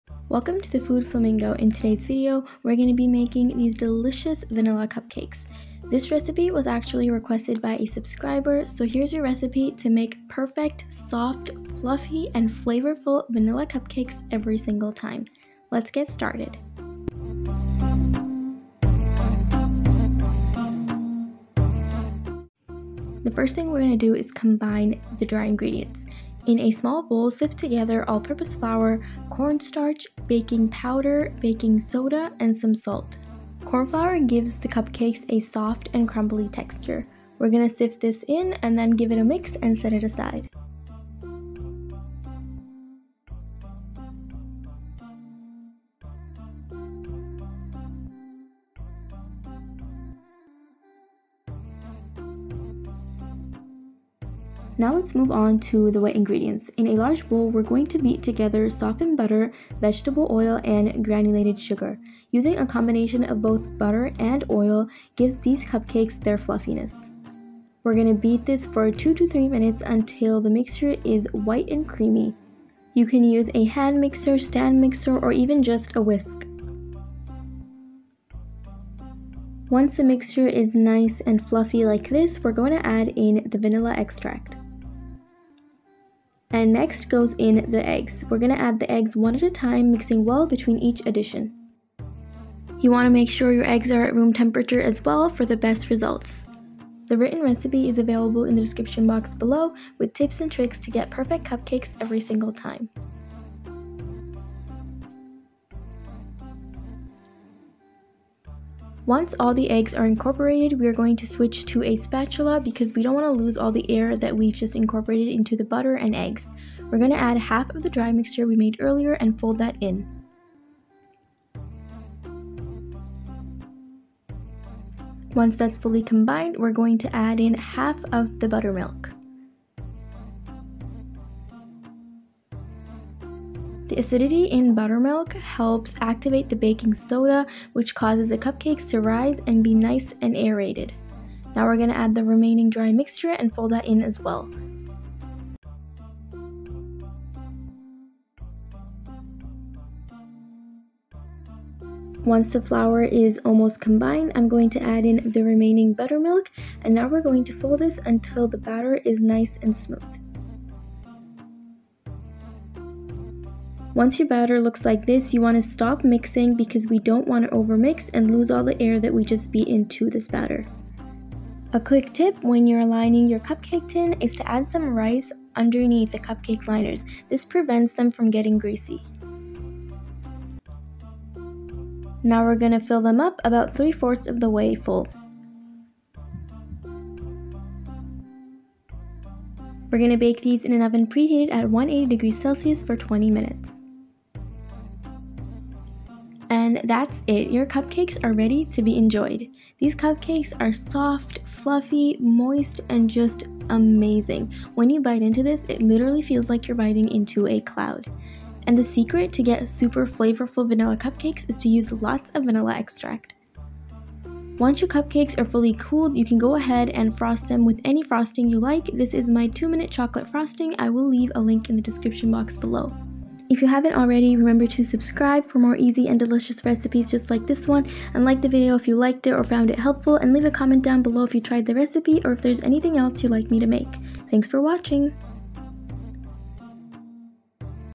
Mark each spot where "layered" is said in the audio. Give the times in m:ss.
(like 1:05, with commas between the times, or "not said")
not said.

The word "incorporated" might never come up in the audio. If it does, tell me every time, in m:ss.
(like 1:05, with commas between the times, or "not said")
1:50, 1:54.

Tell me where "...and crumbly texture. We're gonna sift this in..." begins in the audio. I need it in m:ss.
0:35.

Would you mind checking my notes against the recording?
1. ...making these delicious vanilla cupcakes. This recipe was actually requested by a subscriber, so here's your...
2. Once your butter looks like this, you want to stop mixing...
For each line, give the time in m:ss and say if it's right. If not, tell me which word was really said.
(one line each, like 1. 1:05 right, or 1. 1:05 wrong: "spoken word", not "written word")
1. 0:03 right
2. 2:43 wrong: "batter", not "butter".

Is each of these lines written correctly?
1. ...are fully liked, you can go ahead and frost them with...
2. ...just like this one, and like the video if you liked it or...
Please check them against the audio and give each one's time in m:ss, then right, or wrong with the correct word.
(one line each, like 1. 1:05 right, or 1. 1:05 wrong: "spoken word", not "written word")
1. 3:35 wrong: "cooled", not "liked"
2. 3:47 right.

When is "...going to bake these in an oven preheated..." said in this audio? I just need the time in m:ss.
3:09.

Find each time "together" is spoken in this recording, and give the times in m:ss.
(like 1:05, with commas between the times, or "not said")
0:27, 0:58.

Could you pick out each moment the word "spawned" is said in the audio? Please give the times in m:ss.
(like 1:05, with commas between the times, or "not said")
not said.